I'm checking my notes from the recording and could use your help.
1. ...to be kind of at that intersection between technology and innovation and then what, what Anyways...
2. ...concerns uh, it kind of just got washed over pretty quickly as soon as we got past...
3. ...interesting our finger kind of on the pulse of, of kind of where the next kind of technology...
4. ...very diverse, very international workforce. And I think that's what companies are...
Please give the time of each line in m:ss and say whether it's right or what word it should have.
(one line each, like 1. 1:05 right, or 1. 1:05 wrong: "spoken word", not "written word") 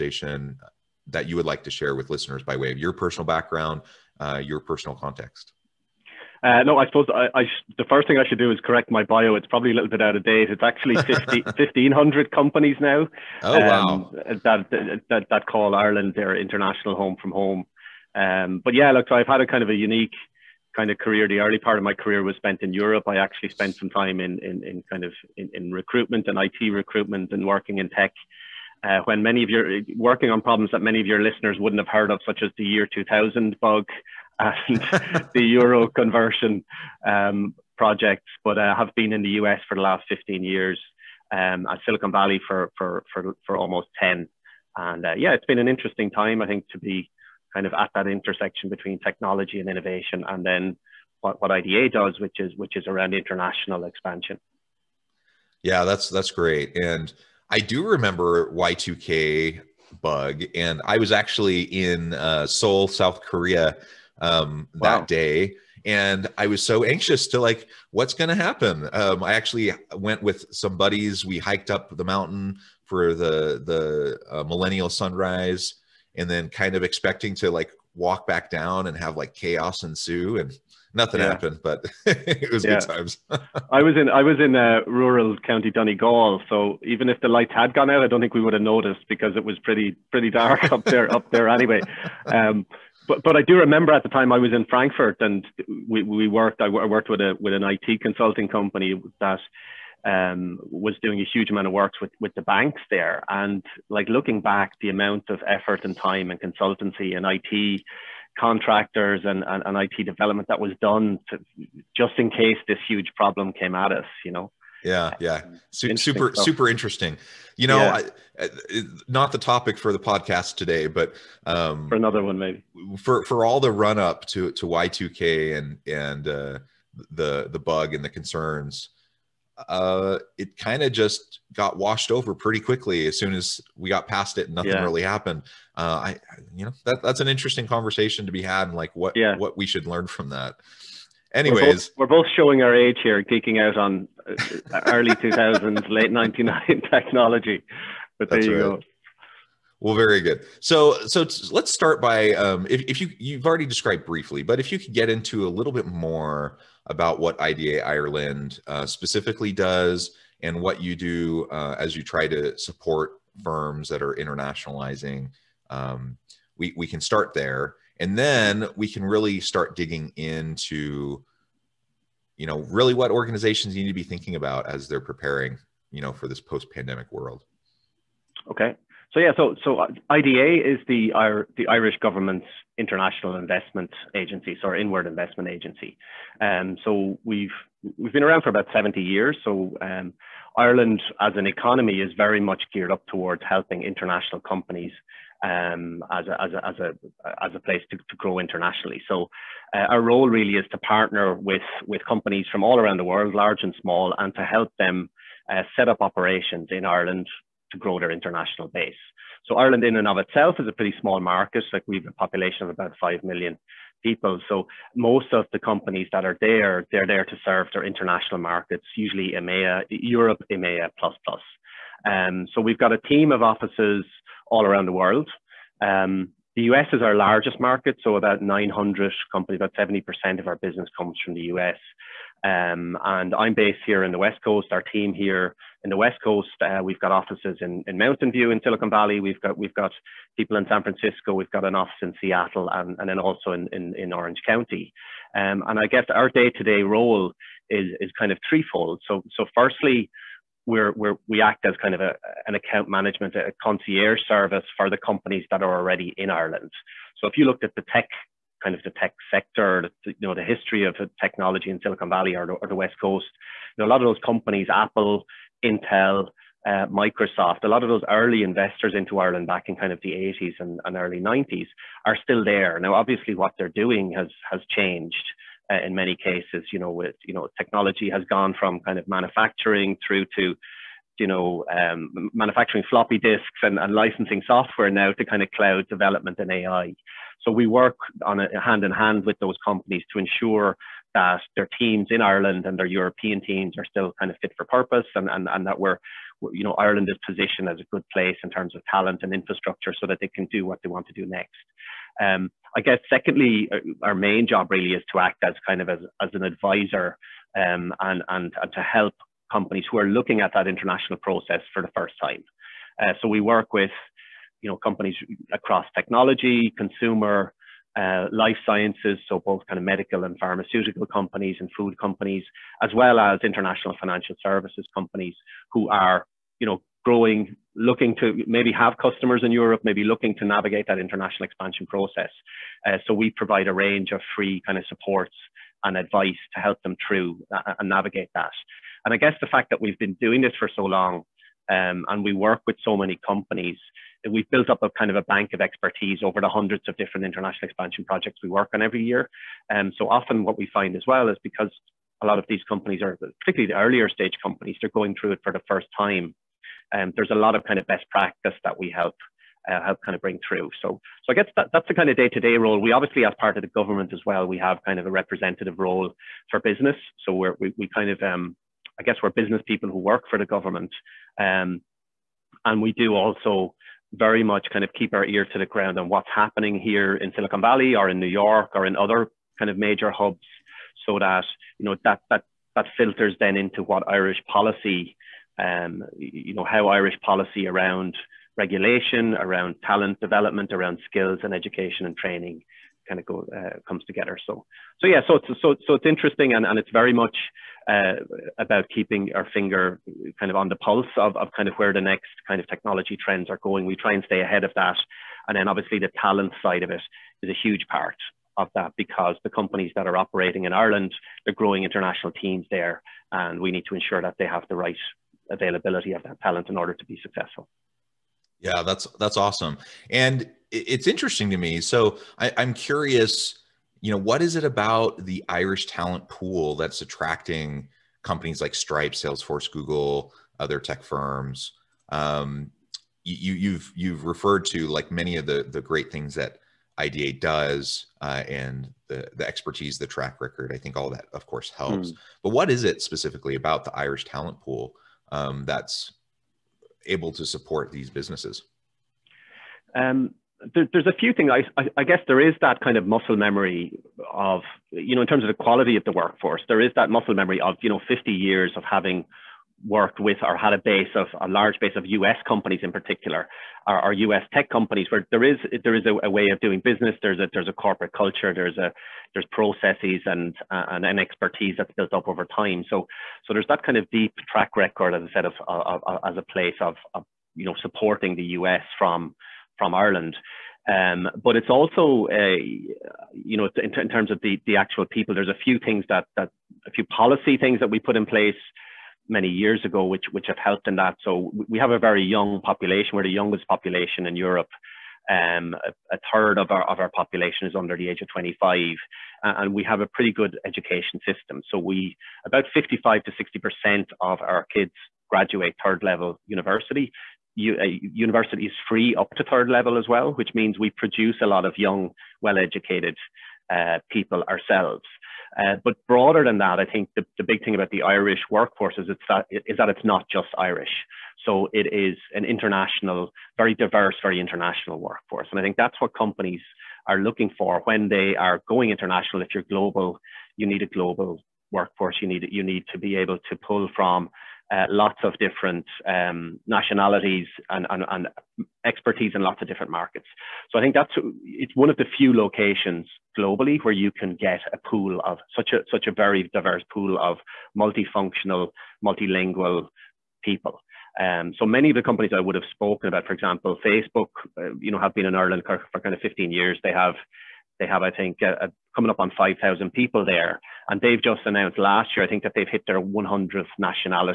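1. 0:46 wrong: "IDA", not "Anyways"
2. 2:08 right
3. 6:38 wrong: "keeping", not "interesting"
4. 8:43 right.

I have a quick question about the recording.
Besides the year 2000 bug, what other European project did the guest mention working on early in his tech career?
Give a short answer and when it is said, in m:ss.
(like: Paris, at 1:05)
The euro conversion, at 0:35.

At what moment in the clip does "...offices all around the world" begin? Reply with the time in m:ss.
3:43.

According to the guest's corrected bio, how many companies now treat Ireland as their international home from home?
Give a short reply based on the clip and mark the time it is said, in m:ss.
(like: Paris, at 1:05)
1,500, at 0:11.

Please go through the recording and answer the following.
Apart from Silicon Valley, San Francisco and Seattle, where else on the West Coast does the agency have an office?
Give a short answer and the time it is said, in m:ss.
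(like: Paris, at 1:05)
Orange County, at 4:04.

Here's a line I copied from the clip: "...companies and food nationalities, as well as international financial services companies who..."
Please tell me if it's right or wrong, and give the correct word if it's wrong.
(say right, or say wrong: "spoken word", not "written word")
wrong: "companies", not "nationalities".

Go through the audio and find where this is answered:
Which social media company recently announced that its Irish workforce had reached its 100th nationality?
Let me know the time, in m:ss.
9:13.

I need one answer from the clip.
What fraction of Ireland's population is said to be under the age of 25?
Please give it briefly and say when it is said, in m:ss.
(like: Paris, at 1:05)
A third, at 8:16.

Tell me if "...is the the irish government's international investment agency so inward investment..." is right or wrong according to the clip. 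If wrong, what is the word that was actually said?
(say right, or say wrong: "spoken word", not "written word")
right.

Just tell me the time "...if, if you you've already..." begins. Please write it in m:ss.
2:32.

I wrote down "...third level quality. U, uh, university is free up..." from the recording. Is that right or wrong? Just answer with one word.
wrong.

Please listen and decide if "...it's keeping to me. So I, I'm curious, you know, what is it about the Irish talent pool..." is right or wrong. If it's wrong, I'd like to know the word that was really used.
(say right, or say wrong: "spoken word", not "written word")
wrong: "interesting", not "keeping".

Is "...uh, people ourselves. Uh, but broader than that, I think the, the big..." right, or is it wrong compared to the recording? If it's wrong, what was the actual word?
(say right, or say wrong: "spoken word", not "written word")
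right.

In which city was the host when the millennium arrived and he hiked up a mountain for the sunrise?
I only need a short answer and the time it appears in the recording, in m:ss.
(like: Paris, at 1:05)
Seoul, at 1:02.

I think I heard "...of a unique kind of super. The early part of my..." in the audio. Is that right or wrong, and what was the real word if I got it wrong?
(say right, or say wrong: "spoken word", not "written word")
wrong: "career", not "super".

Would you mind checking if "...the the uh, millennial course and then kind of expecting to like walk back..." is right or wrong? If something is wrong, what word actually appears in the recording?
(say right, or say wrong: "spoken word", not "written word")
wrong: "sunrise", not "course".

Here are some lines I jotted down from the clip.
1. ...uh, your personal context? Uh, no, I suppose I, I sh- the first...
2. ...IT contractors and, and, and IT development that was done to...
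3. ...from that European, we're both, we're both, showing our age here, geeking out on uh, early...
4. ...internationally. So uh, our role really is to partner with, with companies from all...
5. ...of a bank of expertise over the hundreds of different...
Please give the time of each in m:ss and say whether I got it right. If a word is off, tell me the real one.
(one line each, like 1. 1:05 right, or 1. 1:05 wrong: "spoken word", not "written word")
1. 0:04 right
2. 1:47 right
3. 2:20 wrong: "Anyways", not "European"
4. 3:18 right
5. 5:45 right.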